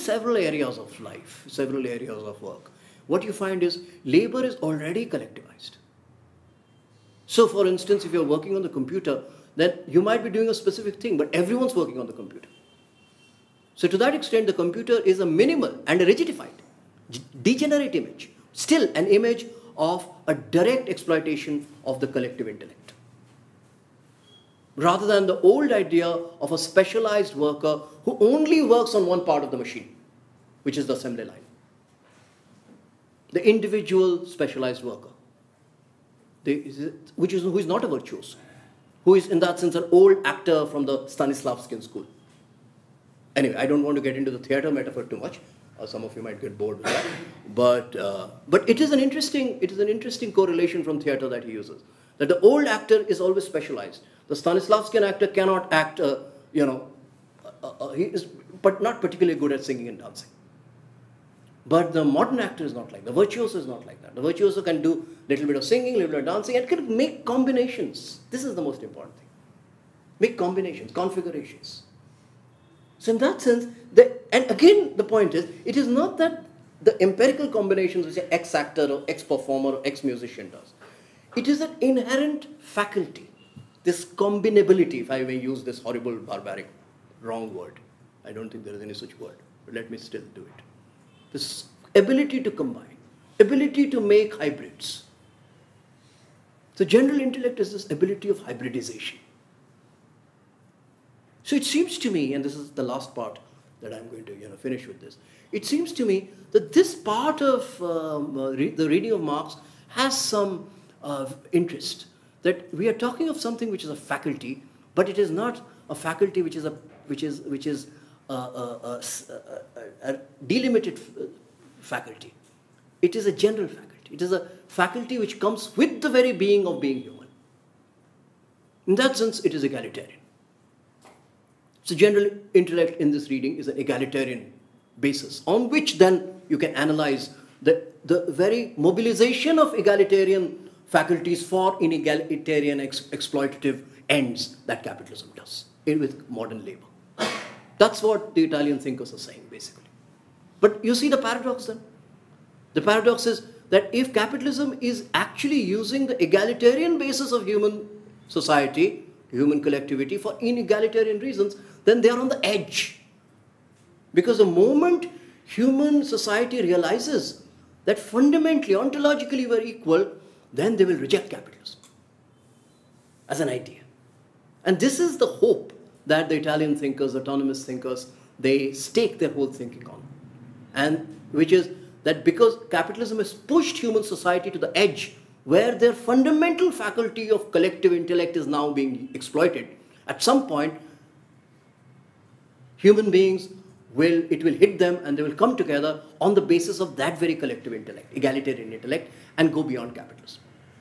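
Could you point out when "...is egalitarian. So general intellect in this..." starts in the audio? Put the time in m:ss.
2:09.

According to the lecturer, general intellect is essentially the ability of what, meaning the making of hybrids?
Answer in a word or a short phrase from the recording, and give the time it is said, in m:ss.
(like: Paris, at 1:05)
Hybridization, at 1:38.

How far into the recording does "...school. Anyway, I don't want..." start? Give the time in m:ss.
0:41.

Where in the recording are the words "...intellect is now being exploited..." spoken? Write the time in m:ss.
3:07.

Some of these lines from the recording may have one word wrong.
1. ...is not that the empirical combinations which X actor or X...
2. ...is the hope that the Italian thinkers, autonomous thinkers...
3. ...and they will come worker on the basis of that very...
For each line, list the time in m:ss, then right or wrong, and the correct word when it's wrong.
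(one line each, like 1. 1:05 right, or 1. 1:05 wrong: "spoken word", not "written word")
1. 1:15 right
2. 2:54 right
3. 3:15 wrong: "together", not "worker".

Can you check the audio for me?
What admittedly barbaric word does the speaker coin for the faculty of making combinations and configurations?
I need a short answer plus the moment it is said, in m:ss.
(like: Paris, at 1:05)
Combinability, at 1:24.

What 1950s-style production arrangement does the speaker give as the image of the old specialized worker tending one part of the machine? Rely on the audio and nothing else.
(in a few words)
The assembly line.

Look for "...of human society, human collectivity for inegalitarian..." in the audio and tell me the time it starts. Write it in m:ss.
2:37.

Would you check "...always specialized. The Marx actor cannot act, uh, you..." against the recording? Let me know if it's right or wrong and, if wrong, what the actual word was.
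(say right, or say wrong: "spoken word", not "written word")
wrong: "Stanislavskian", not "Marx".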